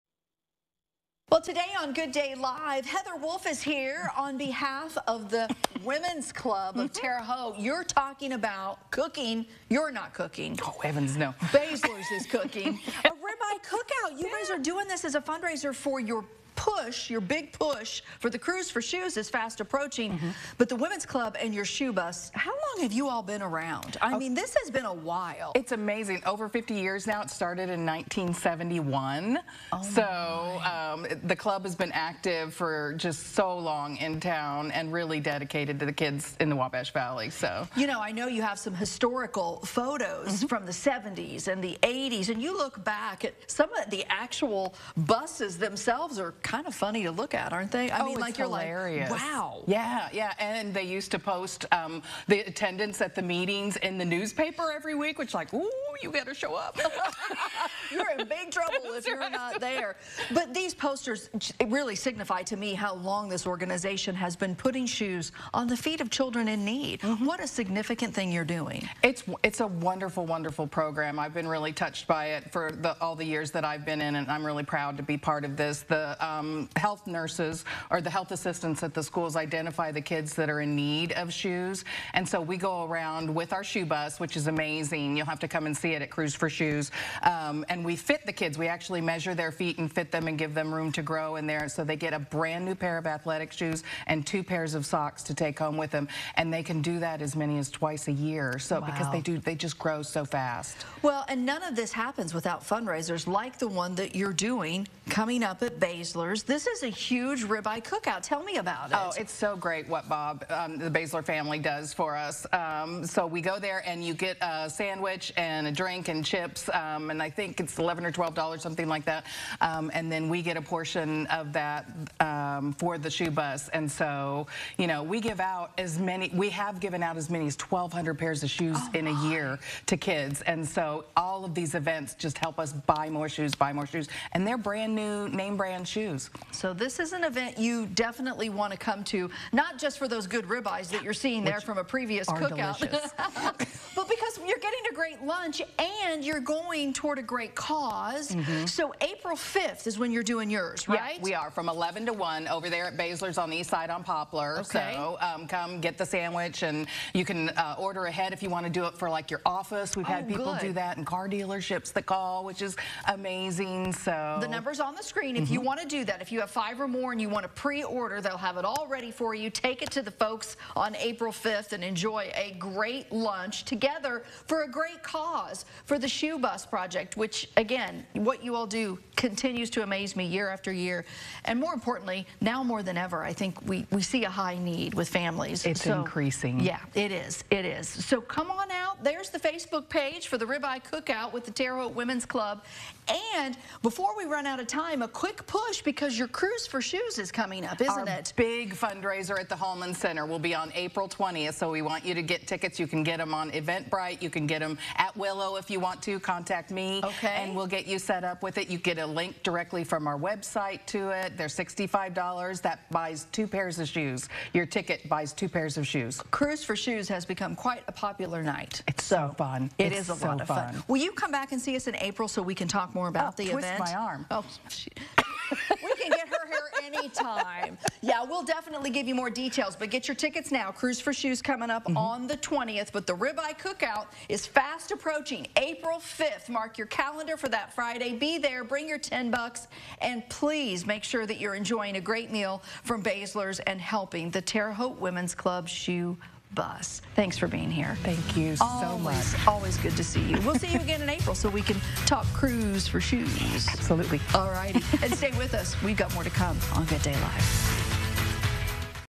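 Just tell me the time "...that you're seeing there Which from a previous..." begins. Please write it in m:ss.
2:20.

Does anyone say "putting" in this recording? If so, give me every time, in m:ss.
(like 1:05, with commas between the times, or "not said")
1:04.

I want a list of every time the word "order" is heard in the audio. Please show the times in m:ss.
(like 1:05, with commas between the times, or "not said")
2:37, 2:47.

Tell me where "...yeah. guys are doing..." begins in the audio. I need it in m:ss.
0:14.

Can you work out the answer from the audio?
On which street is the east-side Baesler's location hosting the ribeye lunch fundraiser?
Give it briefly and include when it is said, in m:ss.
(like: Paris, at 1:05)
Poplar, at 2:34.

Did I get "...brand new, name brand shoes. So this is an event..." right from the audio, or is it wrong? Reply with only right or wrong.
right.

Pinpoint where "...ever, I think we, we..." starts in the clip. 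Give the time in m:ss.
3:02.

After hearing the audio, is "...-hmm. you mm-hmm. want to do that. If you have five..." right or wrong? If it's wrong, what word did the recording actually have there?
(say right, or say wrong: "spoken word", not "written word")
right.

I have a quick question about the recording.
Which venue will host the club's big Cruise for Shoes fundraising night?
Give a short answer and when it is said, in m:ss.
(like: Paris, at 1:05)
Hulman Center, at 3:19.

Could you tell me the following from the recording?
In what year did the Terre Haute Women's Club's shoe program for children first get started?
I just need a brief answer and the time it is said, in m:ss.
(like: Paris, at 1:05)
1971, at 0:27.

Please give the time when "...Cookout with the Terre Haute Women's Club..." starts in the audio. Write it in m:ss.
3:10.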